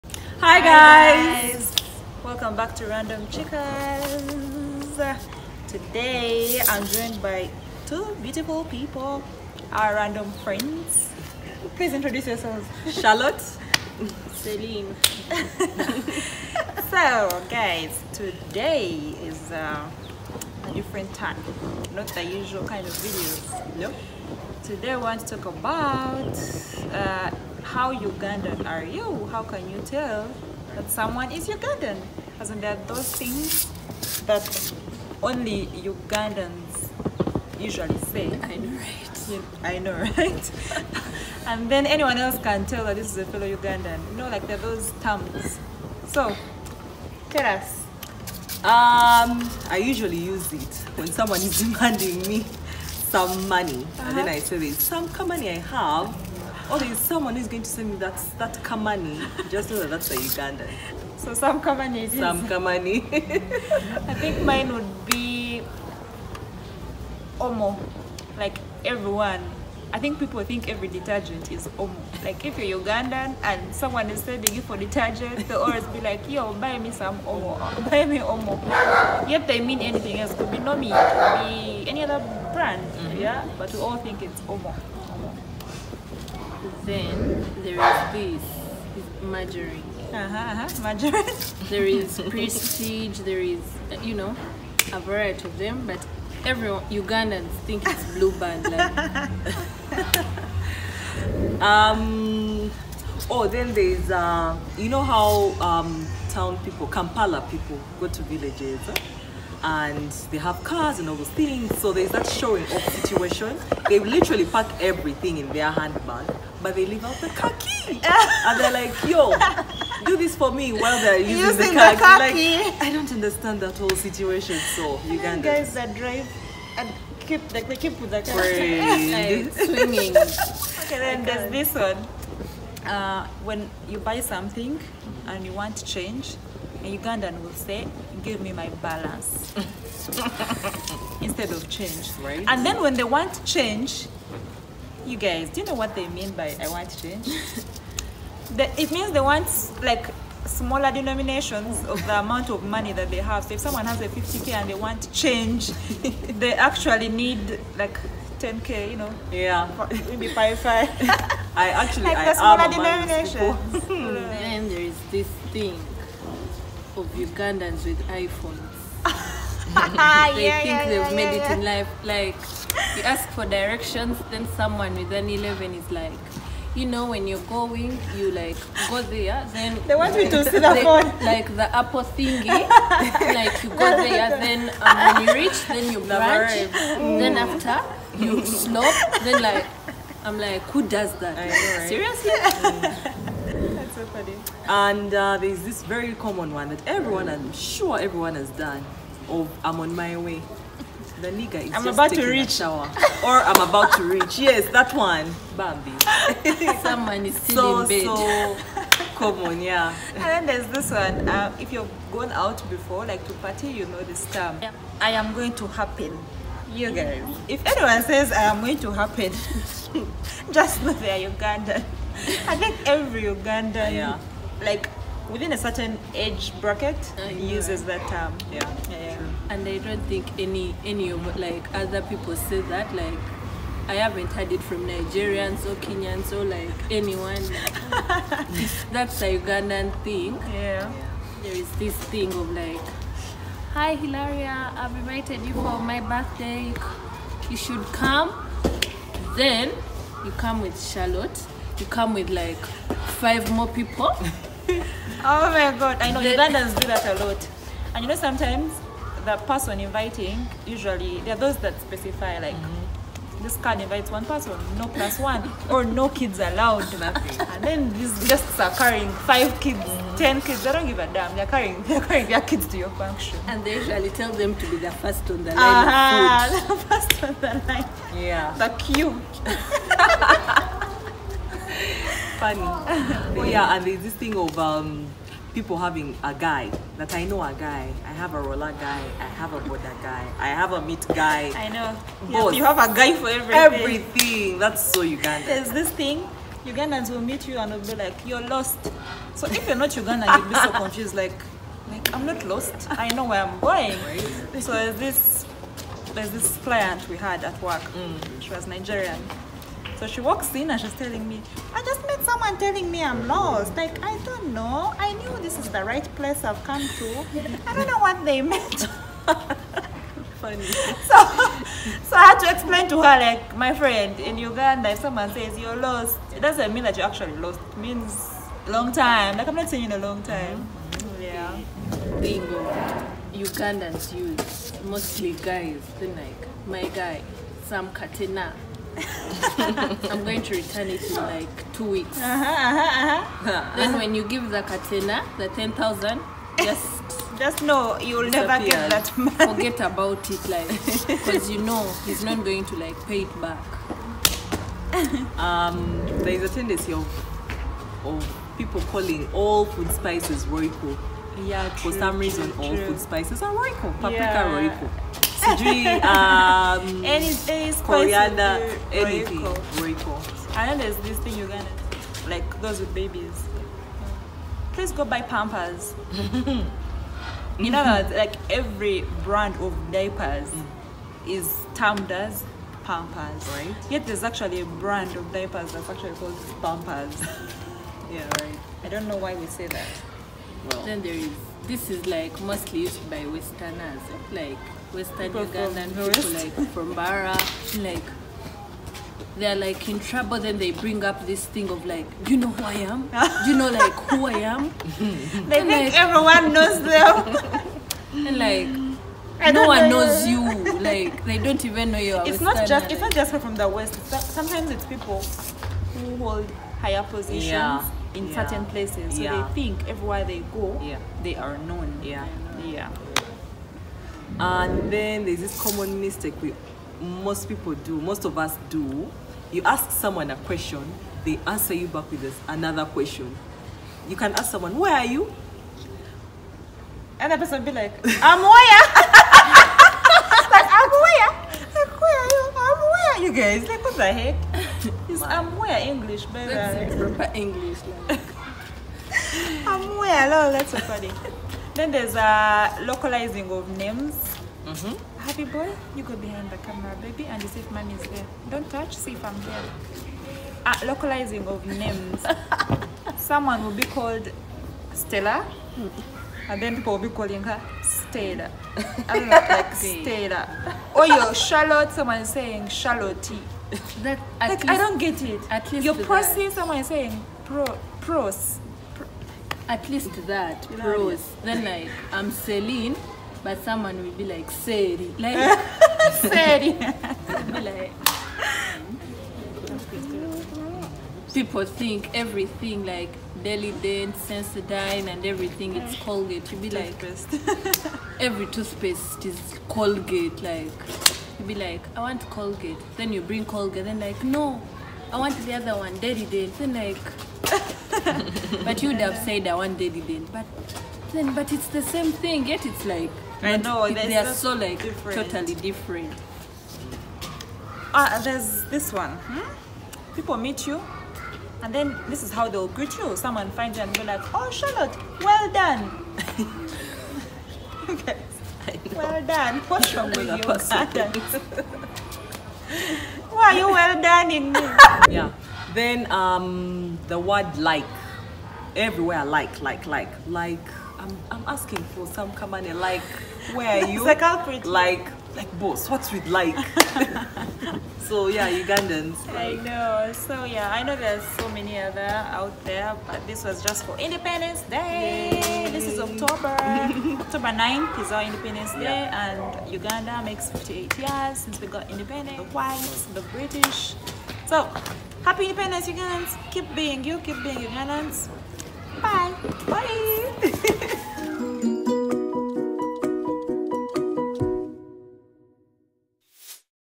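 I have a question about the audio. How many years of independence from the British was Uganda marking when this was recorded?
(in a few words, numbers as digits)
58.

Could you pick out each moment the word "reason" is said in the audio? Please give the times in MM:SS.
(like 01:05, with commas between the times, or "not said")
06:02.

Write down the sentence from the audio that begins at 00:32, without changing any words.
Because there are those things that only Ugandans usually say.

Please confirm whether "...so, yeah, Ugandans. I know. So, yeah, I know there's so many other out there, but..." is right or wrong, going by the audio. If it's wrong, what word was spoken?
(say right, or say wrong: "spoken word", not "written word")
right.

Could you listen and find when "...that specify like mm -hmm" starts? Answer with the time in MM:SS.
04:21.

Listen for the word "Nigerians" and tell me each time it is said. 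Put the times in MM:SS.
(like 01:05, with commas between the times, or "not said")
03:54, 05:08.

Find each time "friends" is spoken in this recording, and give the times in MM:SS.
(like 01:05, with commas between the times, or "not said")
00:10, 05:23.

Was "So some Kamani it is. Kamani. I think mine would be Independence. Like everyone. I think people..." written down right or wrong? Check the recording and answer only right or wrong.
wrong.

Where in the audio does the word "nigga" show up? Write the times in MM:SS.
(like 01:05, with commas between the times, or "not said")
03:21.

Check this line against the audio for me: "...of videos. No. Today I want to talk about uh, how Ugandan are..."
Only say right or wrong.
right.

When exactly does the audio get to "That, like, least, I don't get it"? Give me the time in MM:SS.
07:54.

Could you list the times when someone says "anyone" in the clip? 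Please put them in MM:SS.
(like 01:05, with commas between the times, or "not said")
00:41, 03:37, 03:56.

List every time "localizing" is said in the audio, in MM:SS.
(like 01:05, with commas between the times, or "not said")
07:32, 07:40.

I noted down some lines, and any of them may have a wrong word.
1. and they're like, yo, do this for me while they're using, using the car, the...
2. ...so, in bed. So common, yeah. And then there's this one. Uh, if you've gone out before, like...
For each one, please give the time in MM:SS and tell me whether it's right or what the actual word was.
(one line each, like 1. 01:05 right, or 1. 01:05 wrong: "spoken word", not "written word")
1. 01:58 right
2. 03:27 right.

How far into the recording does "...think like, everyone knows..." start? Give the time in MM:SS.
06:45.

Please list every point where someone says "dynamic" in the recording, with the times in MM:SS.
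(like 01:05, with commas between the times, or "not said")
not said.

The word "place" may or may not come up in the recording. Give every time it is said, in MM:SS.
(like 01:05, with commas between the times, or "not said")
05:16, 06:58.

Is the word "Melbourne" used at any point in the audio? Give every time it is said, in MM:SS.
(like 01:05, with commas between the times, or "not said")
not said.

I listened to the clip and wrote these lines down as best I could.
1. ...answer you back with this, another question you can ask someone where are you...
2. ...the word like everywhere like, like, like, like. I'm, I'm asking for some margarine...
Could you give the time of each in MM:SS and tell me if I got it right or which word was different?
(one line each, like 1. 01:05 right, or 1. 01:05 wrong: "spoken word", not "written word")
1. 07:11 right
2. 08:57 wrong: "kamane", not "margarine".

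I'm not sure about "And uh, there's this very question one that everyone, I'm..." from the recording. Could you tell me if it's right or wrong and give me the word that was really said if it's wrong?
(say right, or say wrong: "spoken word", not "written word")
wrong: "common", not "question".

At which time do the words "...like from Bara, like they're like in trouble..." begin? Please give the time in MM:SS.
06:36.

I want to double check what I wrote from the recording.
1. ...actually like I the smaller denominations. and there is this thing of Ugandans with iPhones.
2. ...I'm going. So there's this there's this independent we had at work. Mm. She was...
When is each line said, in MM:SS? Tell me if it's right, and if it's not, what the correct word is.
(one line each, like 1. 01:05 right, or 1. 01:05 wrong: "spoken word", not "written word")
1. 02:41 right
2. 05:03 wrong: "client", not "independent".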